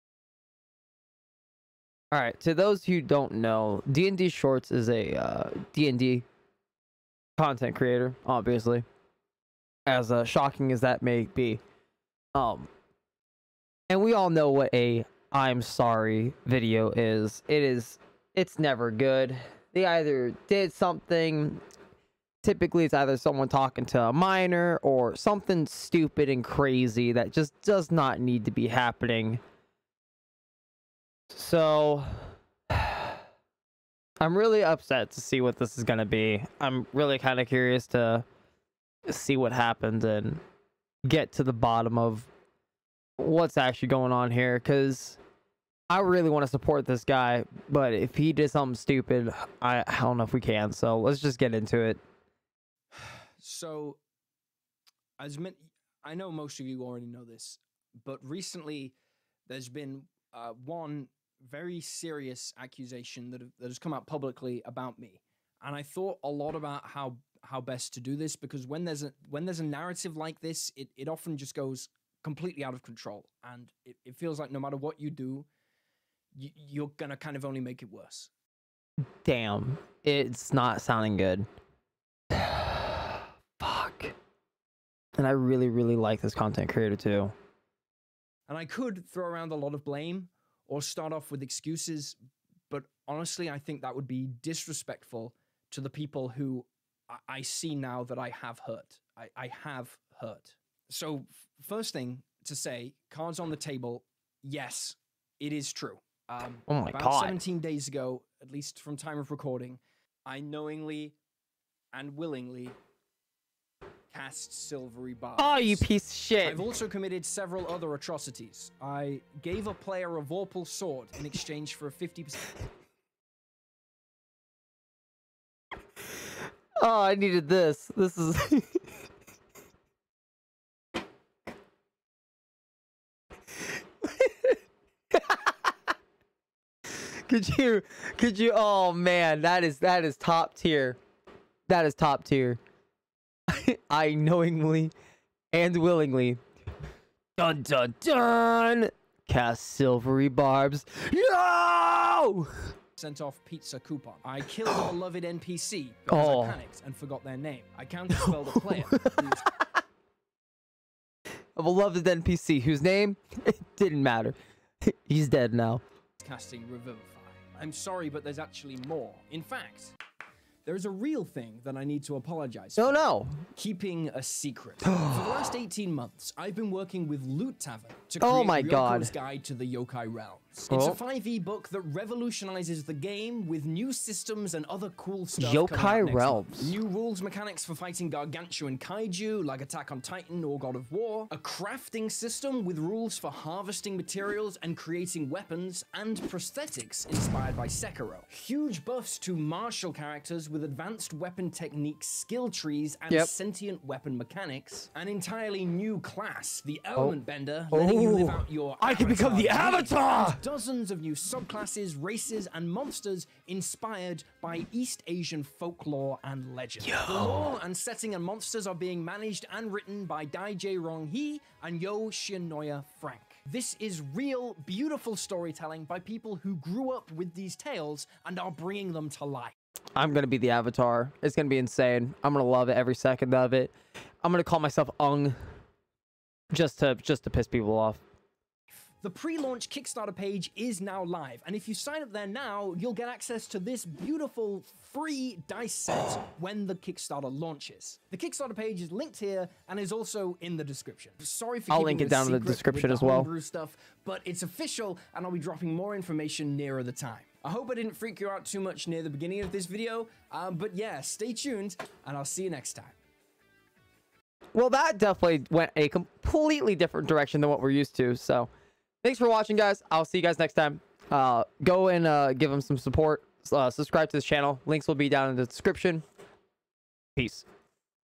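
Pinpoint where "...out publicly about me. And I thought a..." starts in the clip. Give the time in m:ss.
1:03.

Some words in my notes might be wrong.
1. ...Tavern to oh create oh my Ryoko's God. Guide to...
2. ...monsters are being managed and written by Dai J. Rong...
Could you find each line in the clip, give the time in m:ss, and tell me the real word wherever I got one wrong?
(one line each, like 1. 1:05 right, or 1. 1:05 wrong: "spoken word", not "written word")
1. 2:57 right
2. 3:38 right.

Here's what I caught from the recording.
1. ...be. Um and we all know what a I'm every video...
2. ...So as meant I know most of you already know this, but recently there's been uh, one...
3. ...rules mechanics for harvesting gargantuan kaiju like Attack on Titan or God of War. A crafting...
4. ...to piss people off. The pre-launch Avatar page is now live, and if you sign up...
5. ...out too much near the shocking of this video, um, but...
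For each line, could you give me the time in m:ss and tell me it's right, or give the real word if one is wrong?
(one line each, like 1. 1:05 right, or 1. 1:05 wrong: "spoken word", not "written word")
1. 0:11 wrong: "sorry", not "every"
2. 0:53 right
3. 3:06 wrong: "fighting", not "harvesting"
4. 3:57 wrong: "Kickstarter", not "Avatar"
5. 4:18 wrong: "beginning", not "shocking".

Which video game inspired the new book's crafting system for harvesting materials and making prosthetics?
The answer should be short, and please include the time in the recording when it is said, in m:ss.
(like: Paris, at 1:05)
Sekiro, at 3:17.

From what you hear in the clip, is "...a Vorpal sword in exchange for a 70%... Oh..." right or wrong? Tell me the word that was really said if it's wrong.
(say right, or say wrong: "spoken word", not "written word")
wrong: "50", not "70".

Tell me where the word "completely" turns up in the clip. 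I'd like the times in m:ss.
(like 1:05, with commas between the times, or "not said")
1:12, 4:25.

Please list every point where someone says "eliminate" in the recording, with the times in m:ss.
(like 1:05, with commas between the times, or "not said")
not said.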